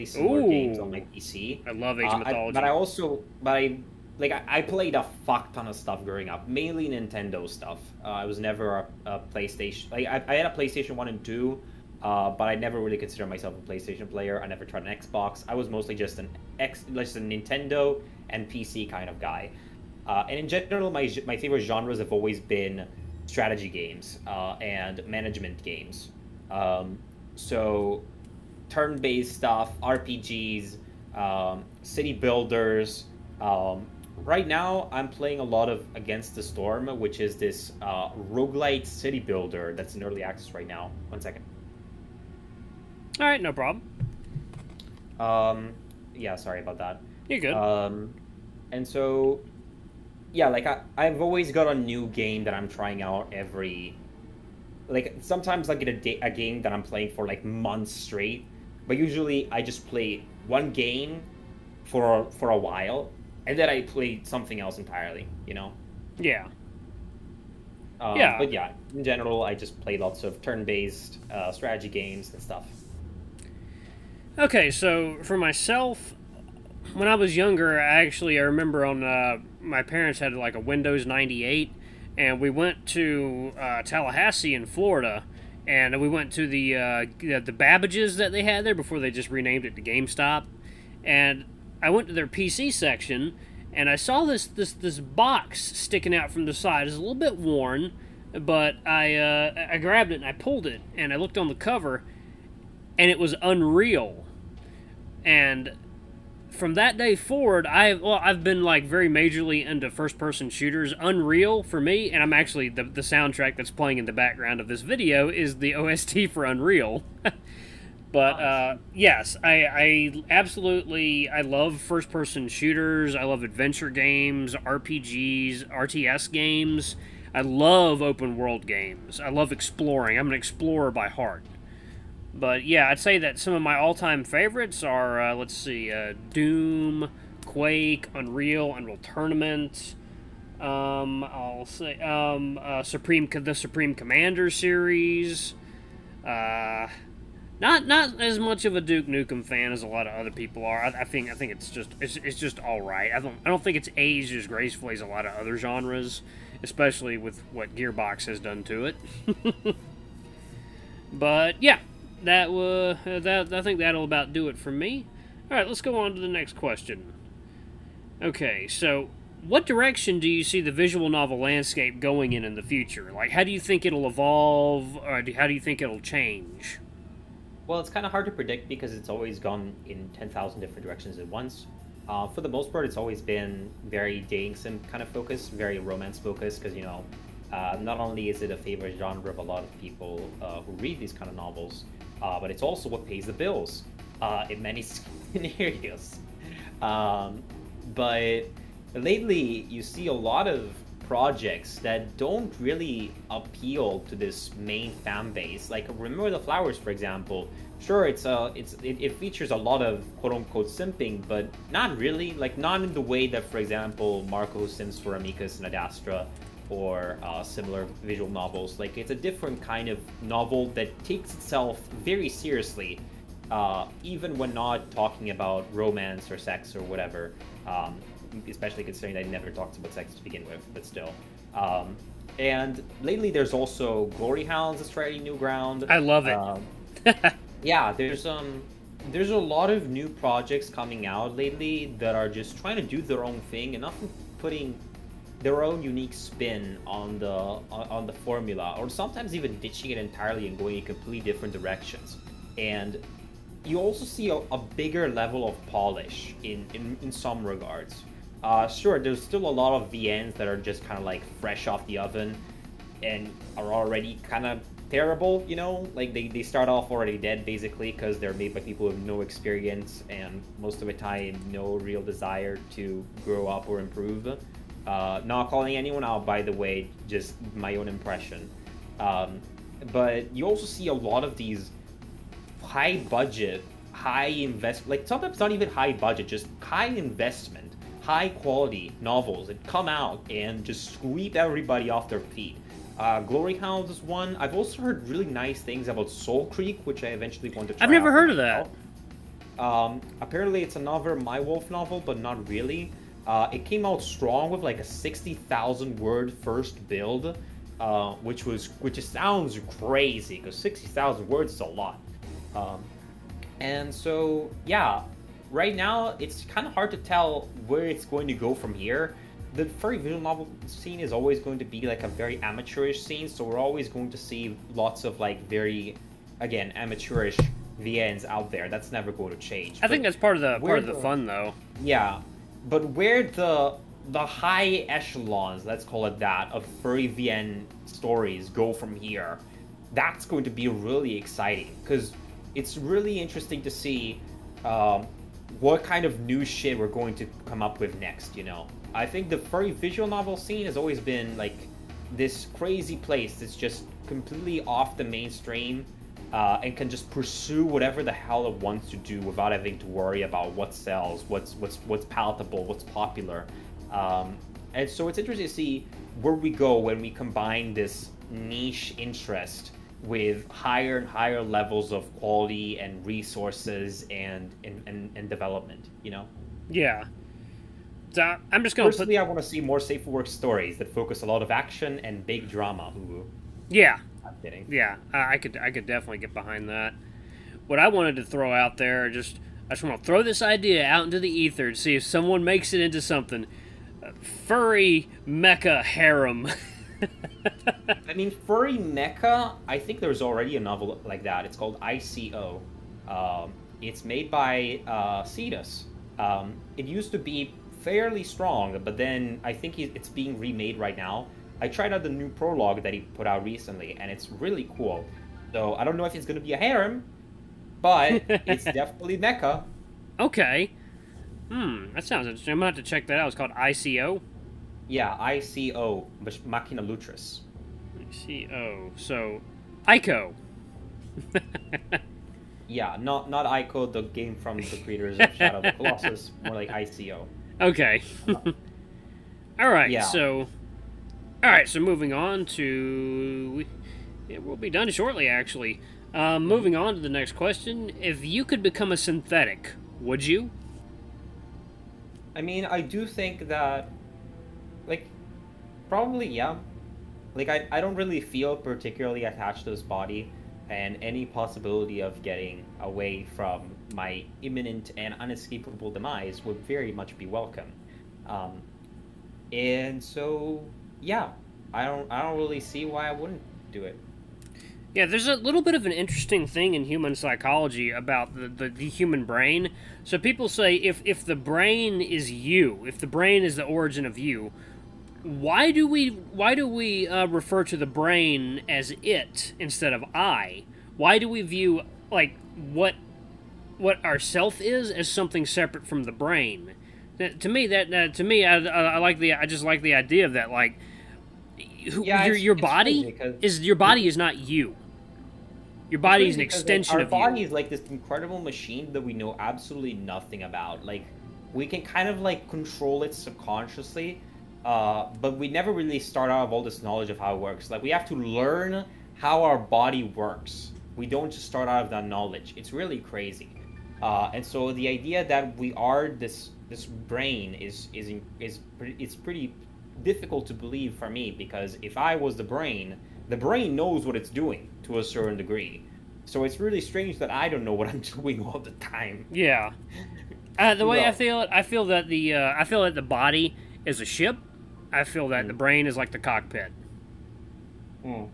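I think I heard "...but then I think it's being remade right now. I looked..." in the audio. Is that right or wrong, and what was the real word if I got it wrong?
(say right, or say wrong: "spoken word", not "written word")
wrong: "tried", not "looked".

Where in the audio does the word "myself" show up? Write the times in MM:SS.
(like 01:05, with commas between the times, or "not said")
00:13, 01:15.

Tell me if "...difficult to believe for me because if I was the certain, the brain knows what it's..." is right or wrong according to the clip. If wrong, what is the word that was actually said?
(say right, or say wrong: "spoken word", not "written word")
wrong: "brain", not "certain".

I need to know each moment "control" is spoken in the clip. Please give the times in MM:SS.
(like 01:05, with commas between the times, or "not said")
08:32.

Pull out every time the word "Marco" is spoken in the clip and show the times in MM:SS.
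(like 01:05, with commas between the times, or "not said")
03:34.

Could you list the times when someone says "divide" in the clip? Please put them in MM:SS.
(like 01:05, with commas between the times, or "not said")
not said.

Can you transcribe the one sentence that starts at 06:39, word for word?
I think there's already a novel like that.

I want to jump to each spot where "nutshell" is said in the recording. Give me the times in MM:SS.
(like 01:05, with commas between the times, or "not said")
not said.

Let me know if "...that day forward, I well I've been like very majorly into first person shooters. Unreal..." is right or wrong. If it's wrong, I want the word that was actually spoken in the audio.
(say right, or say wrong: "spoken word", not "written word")
right.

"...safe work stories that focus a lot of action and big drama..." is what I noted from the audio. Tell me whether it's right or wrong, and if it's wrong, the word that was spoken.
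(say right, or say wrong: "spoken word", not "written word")
right.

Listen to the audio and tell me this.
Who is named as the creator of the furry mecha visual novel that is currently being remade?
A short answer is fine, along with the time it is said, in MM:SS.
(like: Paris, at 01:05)
Cetus, at 06:45.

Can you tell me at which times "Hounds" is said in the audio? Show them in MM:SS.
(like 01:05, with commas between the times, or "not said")
03:54, 04:53.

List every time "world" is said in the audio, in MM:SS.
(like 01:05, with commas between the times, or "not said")
02:08.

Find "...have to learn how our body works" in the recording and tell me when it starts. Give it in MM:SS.
08:37.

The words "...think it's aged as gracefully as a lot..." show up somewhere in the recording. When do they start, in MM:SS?
02:33.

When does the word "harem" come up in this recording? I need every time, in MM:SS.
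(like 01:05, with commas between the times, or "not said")
06:35, 06:56.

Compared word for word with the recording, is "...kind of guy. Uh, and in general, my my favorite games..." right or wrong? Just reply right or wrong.
wrong.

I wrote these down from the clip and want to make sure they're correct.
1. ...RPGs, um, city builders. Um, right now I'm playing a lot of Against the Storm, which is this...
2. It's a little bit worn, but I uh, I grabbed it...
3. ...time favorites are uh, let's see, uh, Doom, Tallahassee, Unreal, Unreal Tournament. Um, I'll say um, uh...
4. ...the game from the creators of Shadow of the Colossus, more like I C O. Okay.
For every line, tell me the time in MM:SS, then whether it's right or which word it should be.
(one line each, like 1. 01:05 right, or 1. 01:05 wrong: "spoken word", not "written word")
1. 00:29 right
2. 01:36 right
3. 02:13 wrong: "Quake", not "Tallahassee"
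4. 07:13 right.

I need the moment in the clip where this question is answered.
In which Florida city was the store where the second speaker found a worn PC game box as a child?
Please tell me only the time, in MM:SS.
01:23.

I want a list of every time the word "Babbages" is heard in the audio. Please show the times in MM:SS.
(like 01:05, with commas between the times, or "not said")
01:27.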